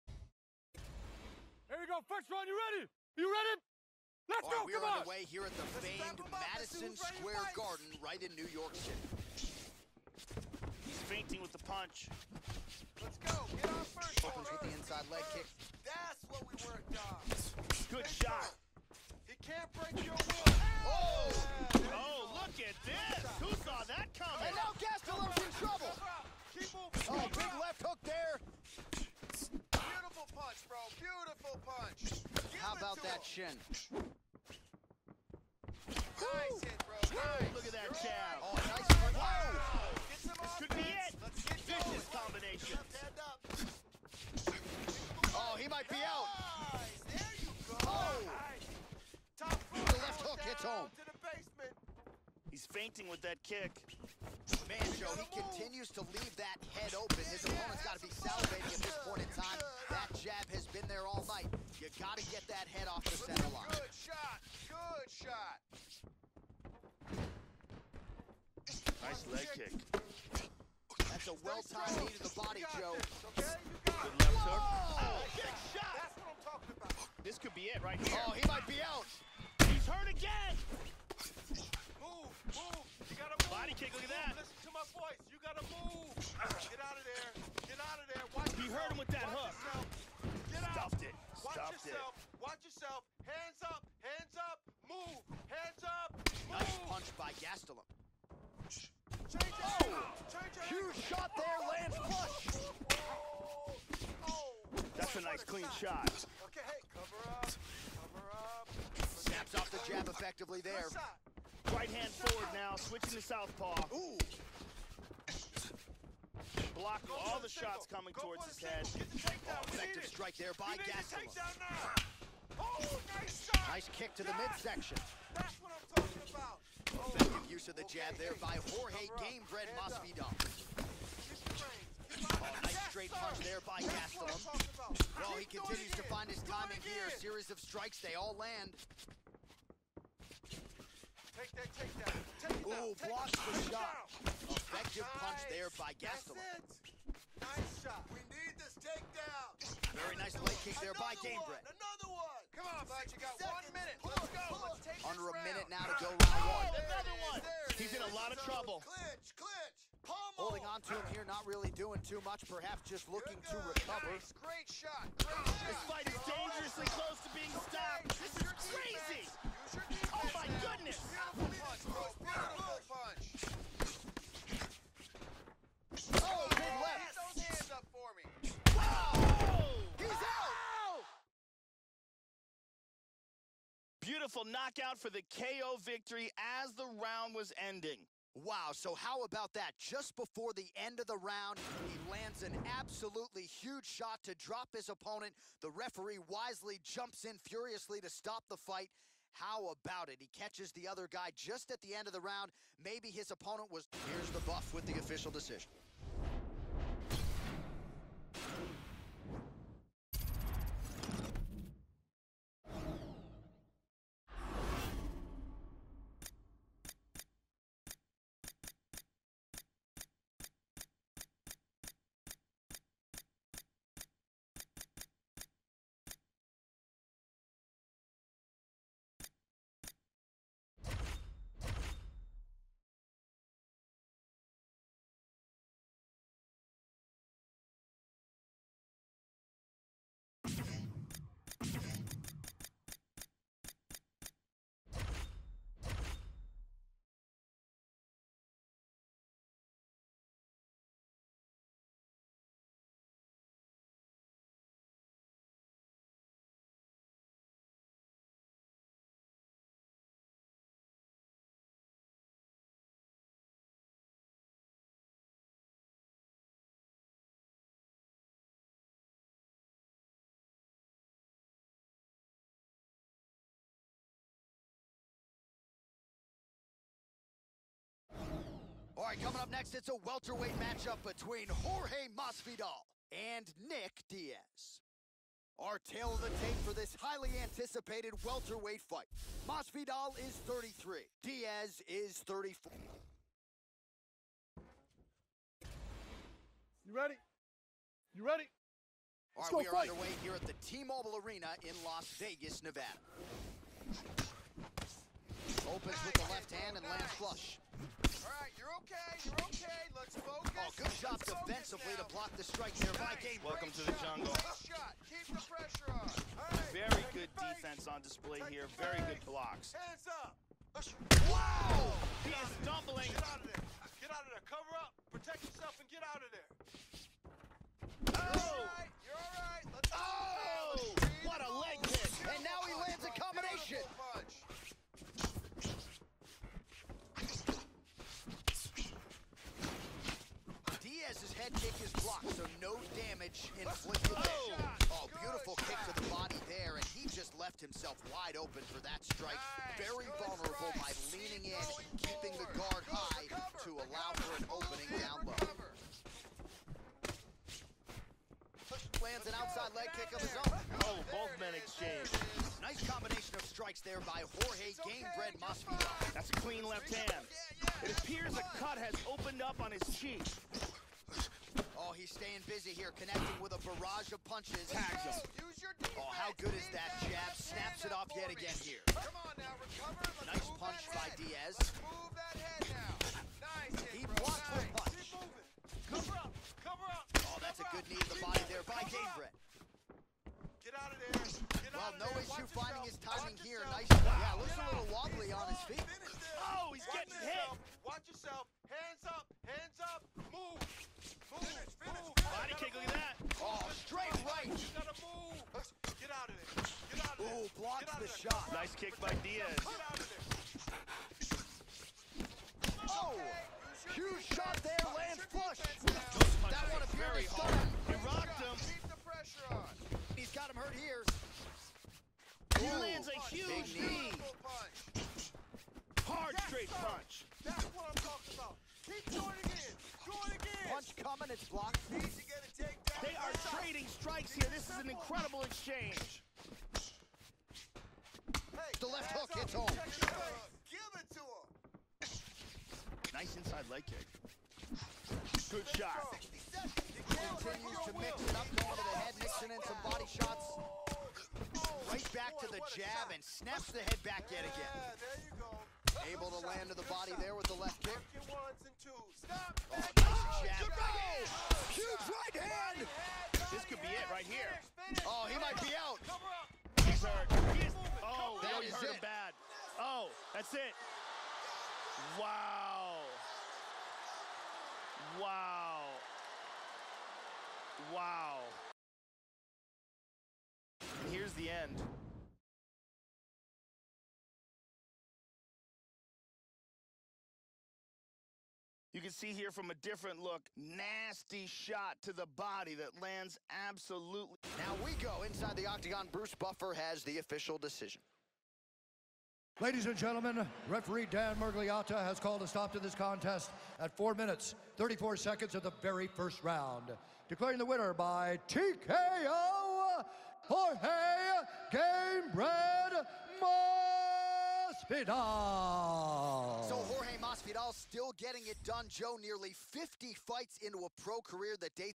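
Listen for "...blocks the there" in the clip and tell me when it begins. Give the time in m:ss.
6:47.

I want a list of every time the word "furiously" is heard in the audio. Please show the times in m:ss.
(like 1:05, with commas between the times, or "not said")
3:17.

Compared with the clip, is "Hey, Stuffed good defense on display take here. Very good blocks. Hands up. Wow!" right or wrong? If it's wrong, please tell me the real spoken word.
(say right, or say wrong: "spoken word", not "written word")
wrong: "Very", not "Stuffed".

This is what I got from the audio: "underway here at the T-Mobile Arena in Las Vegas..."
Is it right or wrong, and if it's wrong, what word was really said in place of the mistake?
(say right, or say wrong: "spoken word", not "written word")
right.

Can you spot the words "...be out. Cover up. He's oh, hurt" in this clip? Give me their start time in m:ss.
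7:45.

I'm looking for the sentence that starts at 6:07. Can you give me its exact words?
It appears a cut has opened up on his cheek.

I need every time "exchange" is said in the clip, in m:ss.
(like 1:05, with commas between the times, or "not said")
6:01, 7:15.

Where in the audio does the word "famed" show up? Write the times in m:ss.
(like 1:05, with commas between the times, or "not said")
0:05.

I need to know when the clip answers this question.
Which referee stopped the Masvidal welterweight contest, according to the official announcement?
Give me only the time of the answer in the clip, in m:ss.
8:21.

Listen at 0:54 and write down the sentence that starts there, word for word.
Man, Joe, he continues to leave that head open.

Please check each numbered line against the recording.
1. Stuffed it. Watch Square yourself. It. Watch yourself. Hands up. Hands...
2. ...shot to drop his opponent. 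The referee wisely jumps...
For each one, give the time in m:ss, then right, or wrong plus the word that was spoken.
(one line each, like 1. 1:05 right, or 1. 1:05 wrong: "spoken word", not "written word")
1. 1:30 wrong: "Stuffed", not "Square"
2. 3:13 right.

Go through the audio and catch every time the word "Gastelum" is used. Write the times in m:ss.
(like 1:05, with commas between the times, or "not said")
1:37, 2:00, 2:14, 2:25.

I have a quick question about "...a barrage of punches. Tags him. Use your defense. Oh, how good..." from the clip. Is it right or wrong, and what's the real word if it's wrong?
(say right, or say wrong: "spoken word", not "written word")
right.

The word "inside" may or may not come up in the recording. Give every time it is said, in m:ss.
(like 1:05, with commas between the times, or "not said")
0:14, 7:23, 8:15.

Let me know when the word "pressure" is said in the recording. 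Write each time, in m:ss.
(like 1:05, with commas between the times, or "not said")
5:15, 6:59.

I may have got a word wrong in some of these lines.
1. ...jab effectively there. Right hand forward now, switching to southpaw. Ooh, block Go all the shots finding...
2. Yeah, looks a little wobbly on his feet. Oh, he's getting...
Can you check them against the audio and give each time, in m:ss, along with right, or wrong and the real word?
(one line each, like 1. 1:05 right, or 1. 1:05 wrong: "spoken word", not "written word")
1. 1:49 wrong: "coming", not "finding"
2. 6:34 right.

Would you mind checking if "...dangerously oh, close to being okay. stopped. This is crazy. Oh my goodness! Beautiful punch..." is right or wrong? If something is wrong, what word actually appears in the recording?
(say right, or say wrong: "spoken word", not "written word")
right.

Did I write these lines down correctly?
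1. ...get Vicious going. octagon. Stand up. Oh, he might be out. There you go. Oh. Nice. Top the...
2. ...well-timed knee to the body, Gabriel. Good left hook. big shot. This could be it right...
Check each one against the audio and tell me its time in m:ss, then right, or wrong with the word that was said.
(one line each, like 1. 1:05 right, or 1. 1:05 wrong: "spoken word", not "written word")
1. 0:41 wrong: "combination", not "octagon"
2. 1:11 wrong: "Joe", not "Gabriel".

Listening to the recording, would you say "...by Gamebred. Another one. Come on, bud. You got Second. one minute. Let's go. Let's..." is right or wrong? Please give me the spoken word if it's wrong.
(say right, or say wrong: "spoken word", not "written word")
right.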